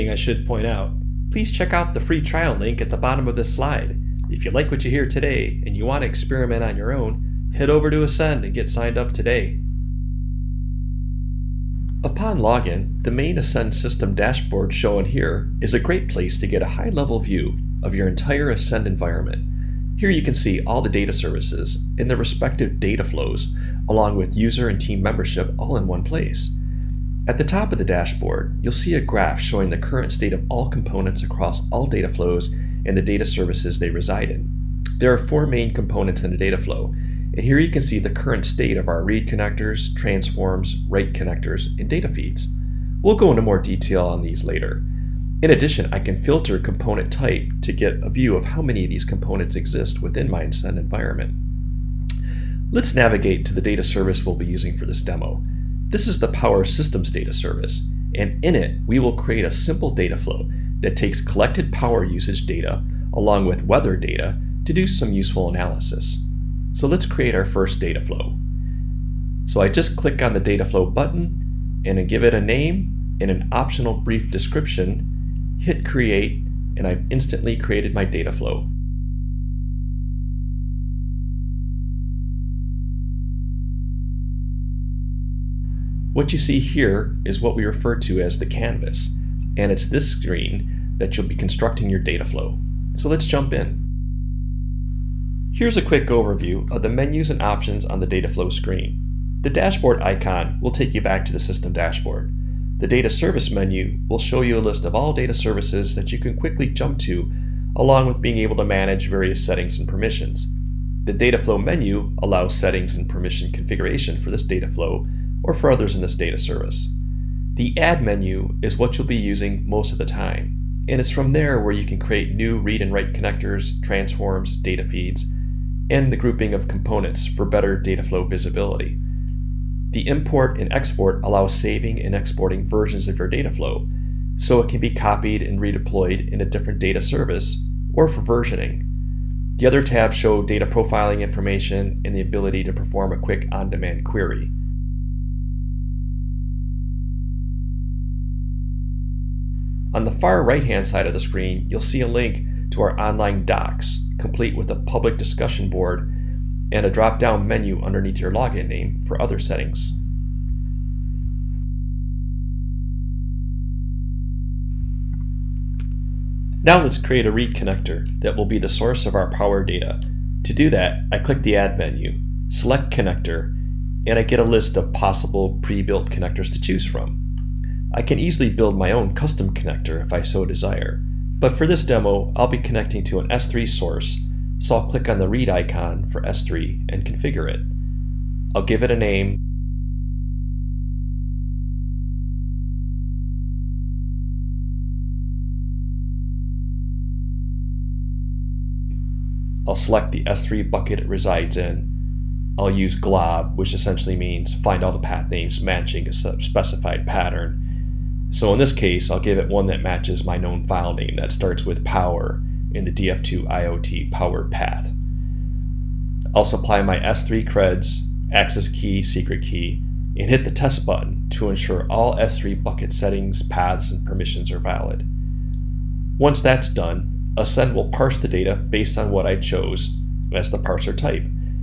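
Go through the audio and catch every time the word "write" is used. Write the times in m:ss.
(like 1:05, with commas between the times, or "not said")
0:40, 2:02.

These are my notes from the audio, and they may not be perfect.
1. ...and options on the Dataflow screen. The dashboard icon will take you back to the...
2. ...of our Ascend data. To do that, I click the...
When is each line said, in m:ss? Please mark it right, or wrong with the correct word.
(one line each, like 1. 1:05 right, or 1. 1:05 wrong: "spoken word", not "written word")
1. 1:37 right
2. 2:49 wrong: "Power", not "Ascend".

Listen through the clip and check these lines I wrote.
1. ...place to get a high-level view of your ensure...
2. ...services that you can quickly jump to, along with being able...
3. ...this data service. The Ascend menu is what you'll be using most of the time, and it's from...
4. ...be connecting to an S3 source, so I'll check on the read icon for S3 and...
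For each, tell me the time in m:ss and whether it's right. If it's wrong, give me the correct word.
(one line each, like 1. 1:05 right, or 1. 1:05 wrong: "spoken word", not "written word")
1. 0:16 wrong: "entire", not "ensure"
2. 1:45 right
3. 1:56 wrong: "Add", not "Ascend"
4. 3:02 wrong: "click", not "check".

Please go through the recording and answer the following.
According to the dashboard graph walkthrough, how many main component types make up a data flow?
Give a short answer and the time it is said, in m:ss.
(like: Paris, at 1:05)
4, at 0:35.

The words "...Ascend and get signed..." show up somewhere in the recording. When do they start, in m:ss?
0:08.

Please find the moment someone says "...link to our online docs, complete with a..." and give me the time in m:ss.
2:32.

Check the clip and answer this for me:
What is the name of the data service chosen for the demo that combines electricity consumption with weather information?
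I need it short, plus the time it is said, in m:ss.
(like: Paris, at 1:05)
Power Systems, at 0:56.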